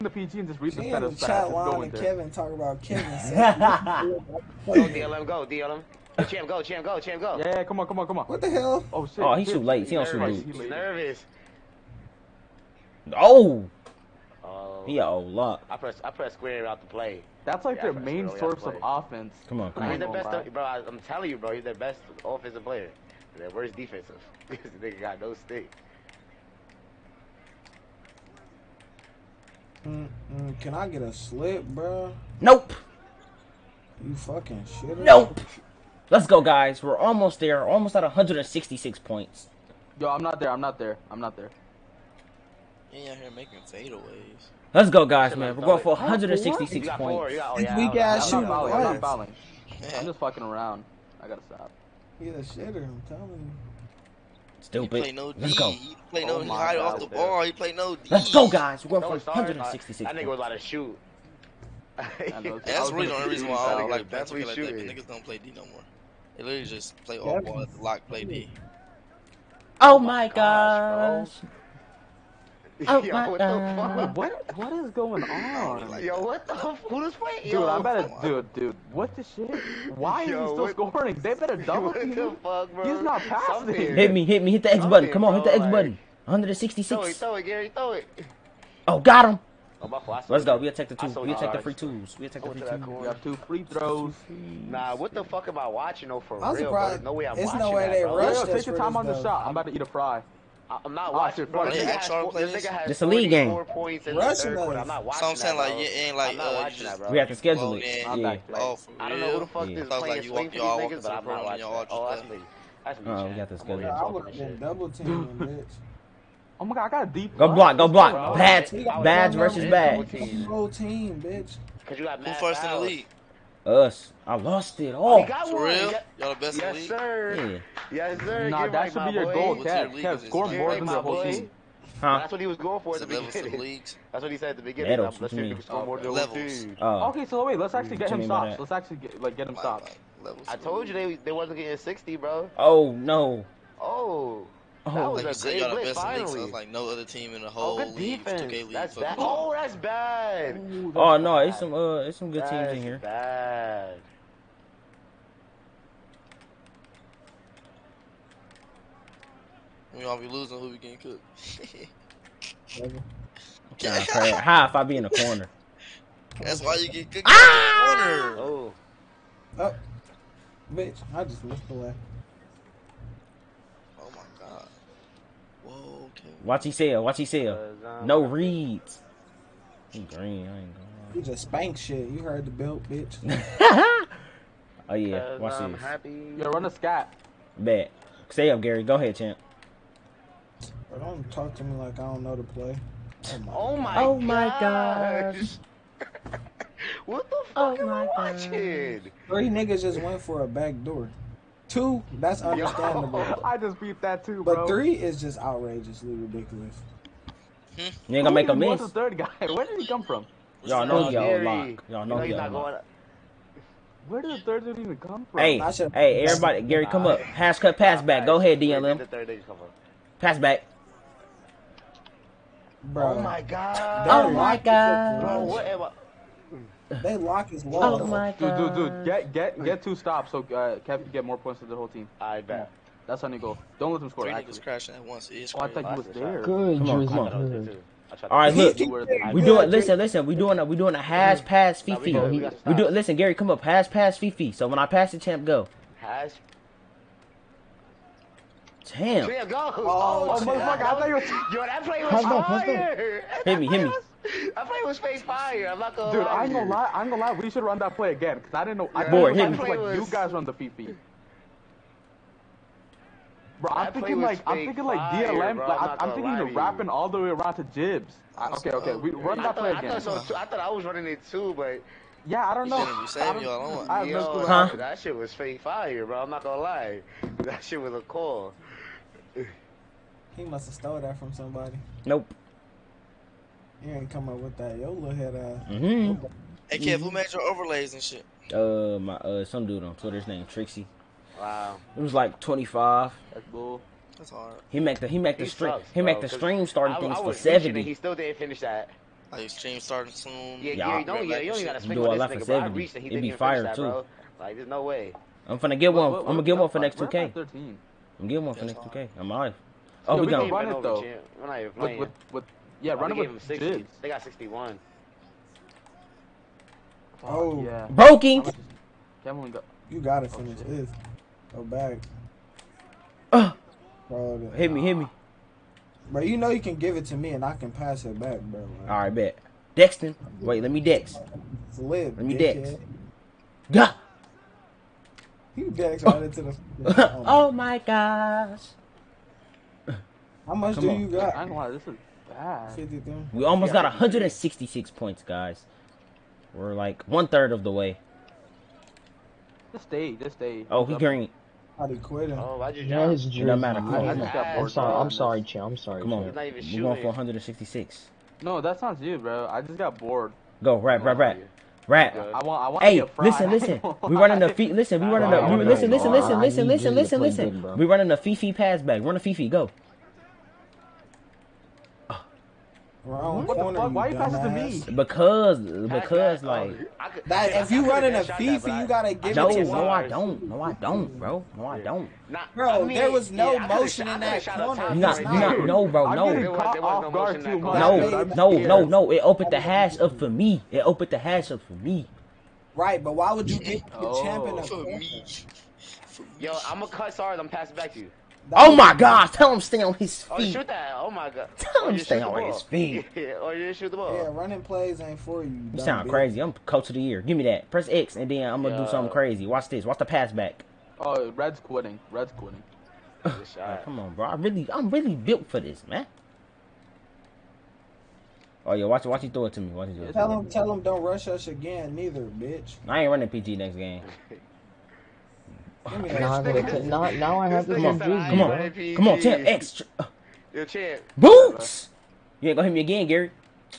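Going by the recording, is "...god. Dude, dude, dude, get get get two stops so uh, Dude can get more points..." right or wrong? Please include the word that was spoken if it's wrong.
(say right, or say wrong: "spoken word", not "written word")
wrong: "Kev", not "Dude".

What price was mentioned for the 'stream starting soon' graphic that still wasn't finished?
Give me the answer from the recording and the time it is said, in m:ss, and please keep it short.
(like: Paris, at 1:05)
70, at 4:57.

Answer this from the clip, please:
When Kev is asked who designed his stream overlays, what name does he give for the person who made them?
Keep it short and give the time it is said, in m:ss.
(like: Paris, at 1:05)
Trixie, at 4:50.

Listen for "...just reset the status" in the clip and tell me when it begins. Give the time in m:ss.
0:00.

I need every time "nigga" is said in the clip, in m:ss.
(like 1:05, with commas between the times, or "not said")
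0:24, 1:04, 1:41, 3:19, 3:54, 5:02.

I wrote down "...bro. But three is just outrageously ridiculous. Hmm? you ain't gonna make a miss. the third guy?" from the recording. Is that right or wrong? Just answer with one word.
right.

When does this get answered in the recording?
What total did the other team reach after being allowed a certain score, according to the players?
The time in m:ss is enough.
5:14.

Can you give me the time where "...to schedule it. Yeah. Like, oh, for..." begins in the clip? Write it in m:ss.
1:47.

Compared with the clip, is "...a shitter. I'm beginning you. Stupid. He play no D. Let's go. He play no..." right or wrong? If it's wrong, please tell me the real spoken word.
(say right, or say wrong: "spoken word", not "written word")
wrong: "telling", not "beginning".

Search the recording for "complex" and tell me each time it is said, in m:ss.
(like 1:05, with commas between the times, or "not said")
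not said.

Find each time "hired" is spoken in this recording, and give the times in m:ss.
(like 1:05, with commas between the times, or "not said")
not said.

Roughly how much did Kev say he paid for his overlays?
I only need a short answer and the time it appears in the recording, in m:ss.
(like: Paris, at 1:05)
25, at 4:52.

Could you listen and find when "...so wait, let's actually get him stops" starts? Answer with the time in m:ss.
2:17.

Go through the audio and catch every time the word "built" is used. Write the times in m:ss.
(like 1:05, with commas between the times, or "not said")
6:55.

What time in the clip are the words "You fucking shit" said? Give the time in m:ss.
0:34.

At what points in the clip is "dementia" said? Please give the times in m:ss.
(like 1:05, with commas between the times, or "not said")
not said.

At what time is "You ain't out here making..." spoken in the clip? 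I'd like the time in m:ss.
0:42.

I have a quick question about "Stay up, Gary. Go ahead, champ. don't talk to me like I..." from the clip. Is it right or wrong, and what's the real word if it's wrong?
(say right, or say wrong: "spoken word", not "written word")
right.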